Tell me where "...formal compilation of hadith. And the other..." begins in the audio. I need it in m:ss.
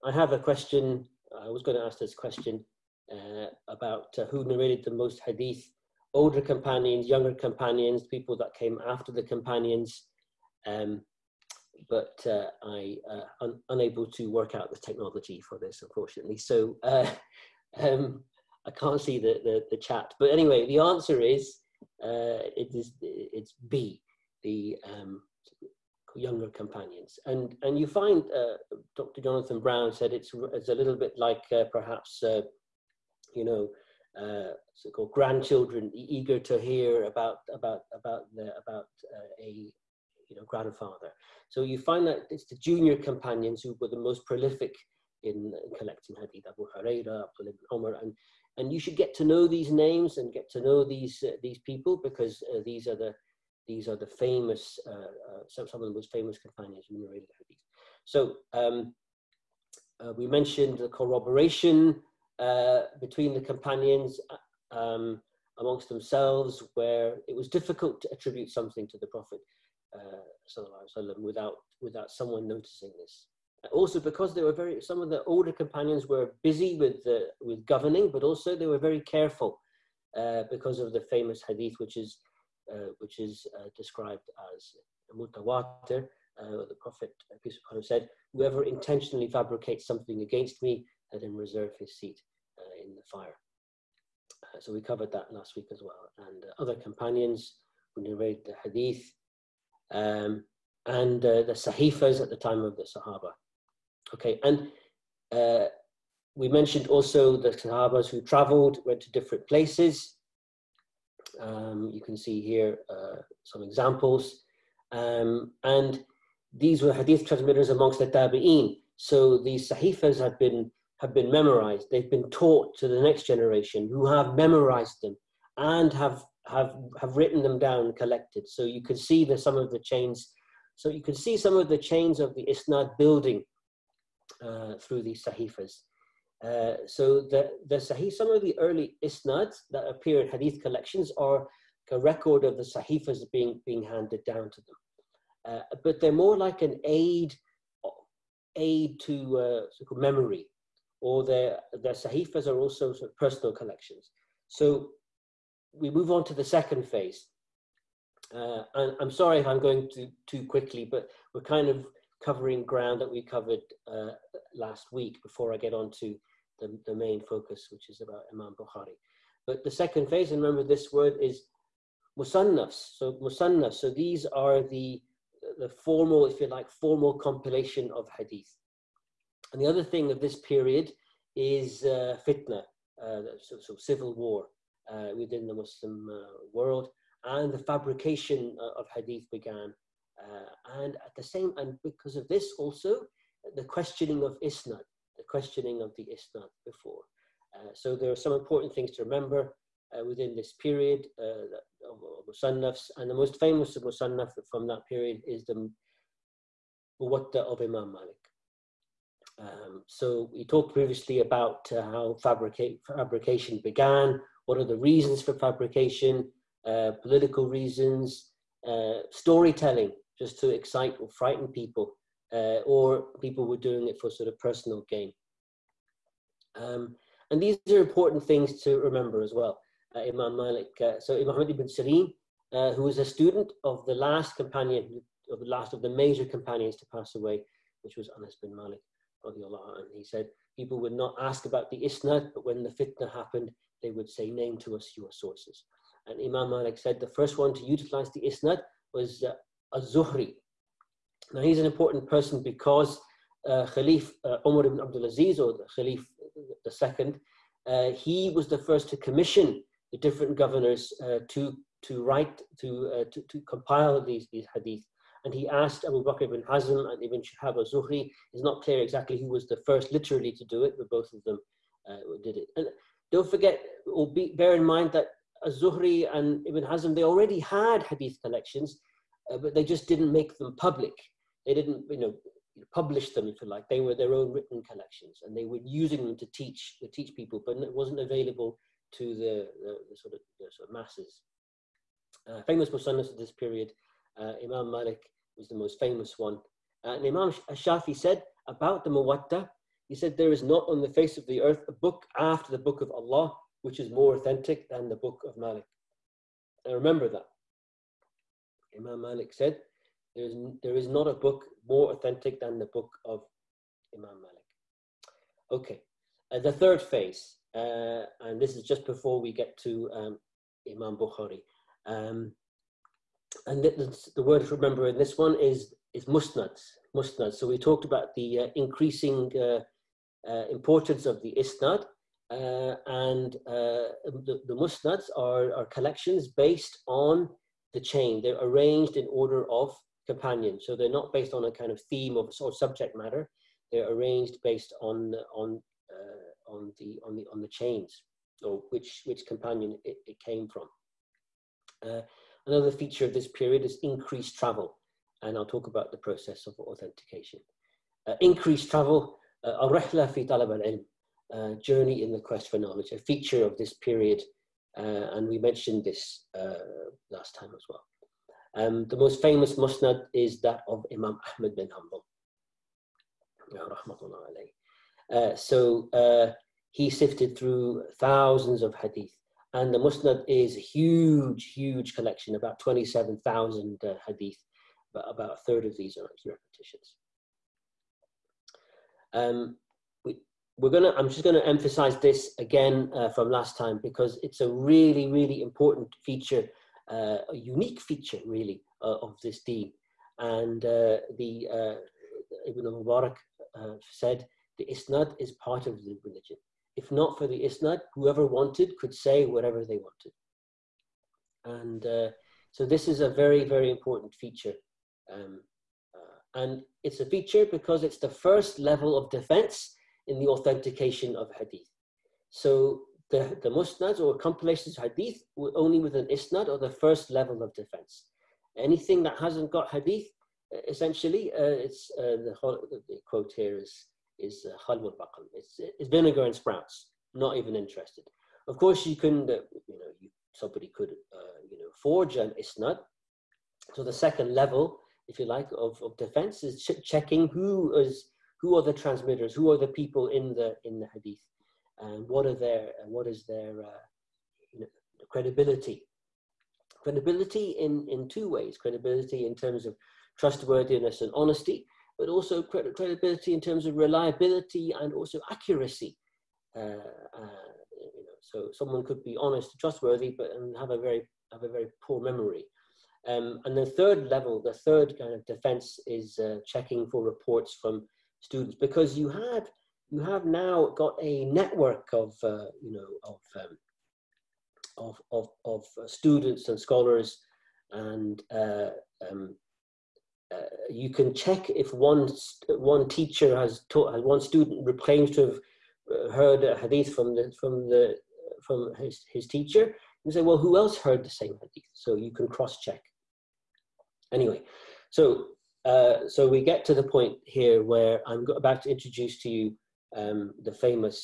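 2:56.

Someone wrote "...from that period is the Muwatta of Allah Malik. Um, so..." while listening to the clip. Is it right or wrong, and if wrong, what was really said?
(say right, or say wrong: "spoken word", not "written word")
wrong: "Imam", not "Allah".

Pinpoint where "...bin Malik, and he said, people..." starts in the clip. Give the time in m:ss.
3:58.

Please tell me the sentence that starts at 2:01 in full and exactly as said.
They've been taught to the next generation who have memorized them and have, have, have written them down and collected.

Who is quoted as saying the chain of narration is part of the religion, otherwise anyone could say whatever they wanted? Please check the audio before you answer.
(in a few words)
Ibn Mubarak.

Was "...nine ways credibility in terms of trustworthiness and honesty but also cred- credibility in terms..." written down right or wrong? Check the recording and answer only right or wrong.
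wrong.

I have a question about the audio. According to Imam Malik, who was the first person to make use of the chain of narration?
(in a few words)
Az-Zuhri.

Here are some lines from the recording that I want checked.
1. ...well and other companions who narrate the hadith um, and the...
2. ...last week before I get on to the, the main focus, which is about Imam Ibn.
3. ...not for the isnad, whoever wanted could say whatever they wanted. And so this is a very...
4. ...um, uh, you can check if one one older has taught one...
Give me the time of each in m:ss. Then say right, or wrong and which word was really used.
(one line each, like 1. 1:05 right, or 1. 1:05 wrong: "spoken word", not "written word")
1. 1:35 right
2. 2:44 wrong: "Bukhari", not "Ibn"
3. 6:46 right
4. 8:09 wrong: "teacher", not "older".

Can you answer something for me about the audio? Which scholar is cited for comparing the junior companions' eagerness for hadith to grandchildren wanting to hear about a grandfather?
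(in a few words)
Jonathan Brown.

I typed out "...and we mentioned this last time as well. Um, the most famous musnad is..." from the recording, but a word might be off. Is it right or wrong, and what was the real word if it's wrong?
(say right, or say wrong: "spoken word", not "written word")
right.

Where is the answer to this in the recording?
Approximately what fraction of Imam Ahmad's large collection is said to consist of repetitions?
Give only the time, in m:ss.
6:25.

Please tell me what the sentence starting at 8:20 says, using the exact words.
You say, well, who else heard the same hadith?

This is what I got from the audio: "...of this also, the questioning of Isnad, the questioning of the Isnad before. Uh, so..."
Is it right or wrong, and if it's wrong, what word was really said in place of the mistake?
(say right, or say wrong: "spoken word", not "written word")
right.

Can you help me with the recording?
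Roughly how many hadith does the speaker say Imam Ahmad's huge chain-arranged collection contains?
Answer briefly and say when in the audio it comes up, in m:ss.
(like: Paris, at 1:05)
27,000, at 6:22.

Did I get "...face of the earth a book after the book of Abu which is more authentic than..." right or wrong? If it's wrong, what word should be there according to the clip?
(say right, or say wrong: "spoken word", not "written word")
wrong: "Allah", not "Abu".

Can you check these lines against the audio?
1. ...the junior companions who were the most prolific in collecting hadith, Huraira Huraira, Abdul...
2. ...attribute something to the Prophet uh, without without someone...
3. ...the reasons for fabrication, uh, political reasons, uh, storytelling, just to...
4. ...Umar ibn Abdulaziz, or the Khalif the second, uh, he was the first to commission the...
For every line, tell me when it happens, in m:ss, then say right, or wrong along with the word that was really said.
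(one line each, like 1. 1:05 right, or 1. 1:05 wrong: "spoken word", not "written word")
1. 0:42 wrong: "Abu", not "Huraira"
2. 1:08 right
3. 3:34 right
4. 4:14 right.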